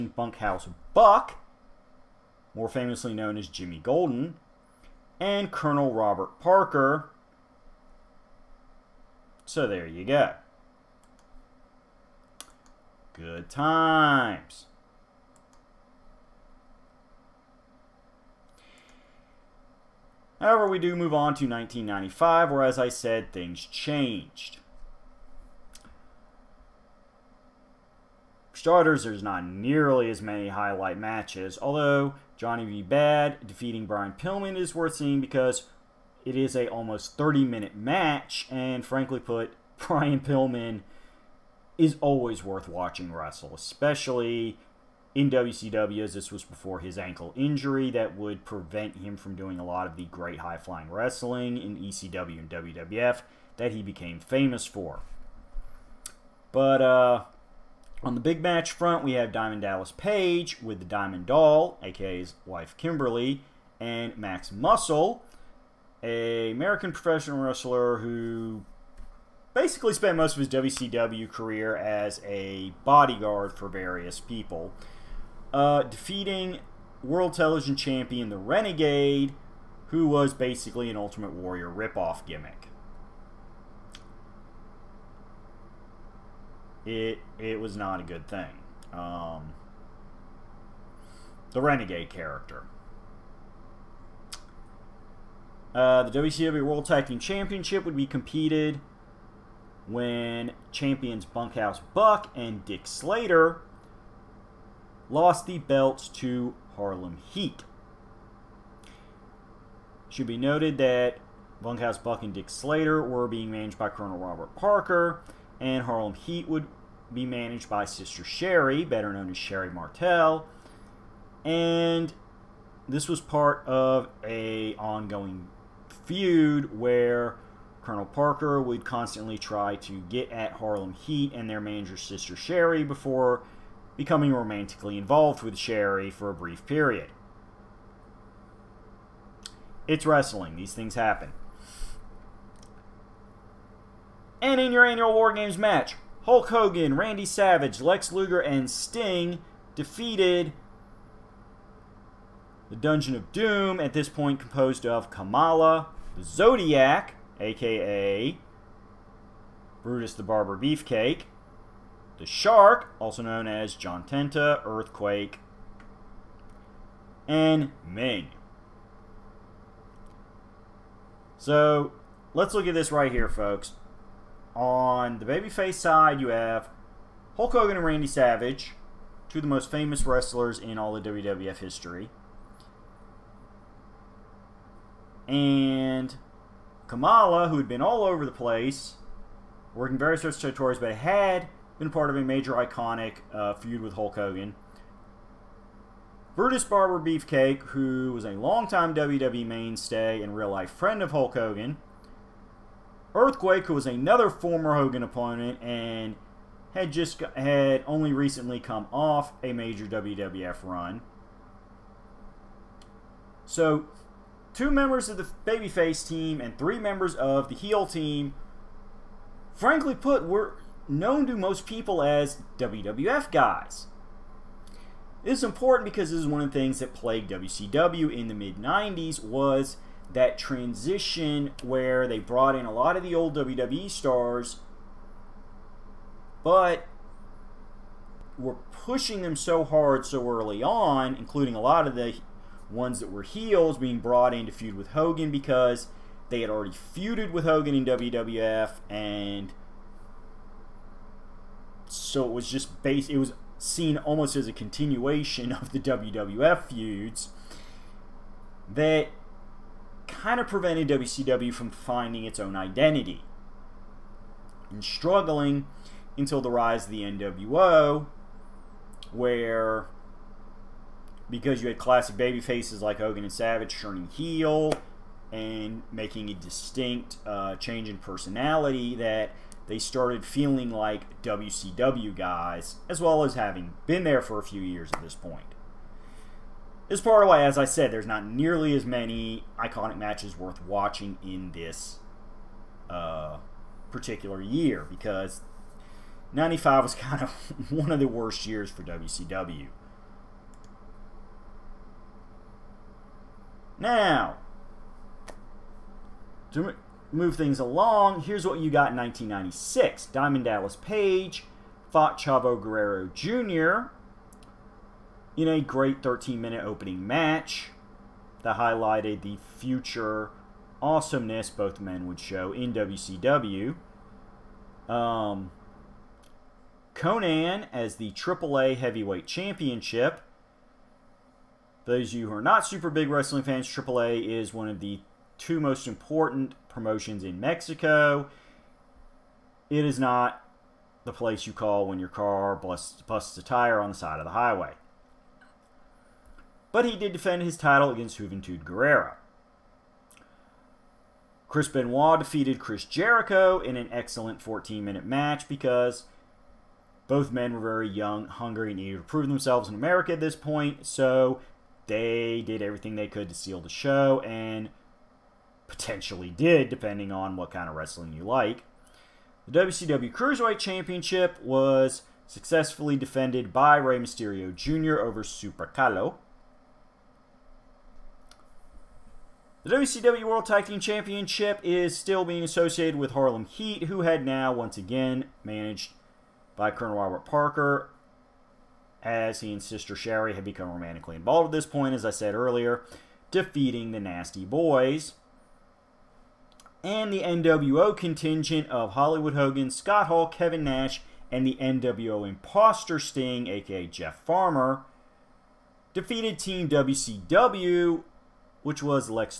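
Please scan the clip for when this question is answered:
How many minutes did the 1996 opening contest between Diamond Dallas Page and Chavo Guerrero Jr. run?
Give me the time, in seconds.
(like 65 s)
316 s.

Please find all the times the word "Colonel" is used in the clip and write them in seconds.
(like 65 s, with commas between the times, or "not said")
5 s, 113 s, 127 s, 386 s.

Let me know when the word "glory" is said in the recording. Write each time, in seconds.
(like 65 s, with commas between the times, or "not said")
not said.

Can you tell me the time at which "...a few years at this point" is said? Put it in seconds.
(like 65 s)
284 s.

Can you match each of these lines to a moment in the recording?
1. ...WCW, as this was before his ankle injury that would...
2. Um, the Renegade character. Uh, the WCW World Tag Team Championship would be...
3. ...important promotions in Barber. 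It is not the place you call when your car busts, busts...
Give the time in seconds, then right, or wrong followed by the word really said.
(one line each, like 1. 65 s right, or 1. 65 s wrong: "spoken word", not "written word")
1. 45 s right
2. 88 s right
3. 335 s wrong: "Mexico", not "Barber".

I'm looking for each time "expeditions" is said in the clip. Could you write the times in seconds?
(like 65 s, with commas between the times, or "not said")
not said.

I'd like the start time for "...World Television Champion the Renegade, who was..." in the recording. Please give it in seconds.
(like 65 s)
77 s.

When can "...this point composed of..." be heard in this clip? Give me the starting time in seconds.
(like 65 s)
153 s.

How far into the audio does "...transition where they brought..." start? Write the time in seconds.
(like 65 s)
230 s.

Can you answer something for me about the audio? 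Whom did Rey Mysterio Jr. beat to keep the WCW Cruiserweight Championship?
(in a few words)
Super Calo.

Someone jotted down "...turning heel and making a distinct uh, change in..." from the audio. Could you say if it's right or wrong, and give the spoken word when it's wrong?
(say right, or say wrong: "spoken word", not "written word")
right.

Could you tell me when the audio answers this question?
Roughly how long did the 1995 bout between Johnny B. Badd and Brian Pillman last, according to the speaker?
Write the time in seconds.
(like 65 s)
36 s.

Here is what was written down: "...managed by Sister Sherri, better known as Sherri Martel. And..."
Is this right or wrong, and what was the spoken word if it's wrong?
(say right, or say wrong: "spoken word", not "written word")
right.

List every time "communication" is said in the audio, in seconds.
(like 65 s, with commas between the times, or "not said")
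not said.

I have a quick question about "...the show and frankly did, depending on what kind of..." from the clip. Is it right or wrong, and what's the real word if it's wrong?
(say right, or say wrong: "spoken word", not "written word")
wrong: "potentially", not "frankly".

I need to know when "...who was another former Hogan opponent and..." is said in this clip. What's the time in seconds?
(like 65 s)
203 s.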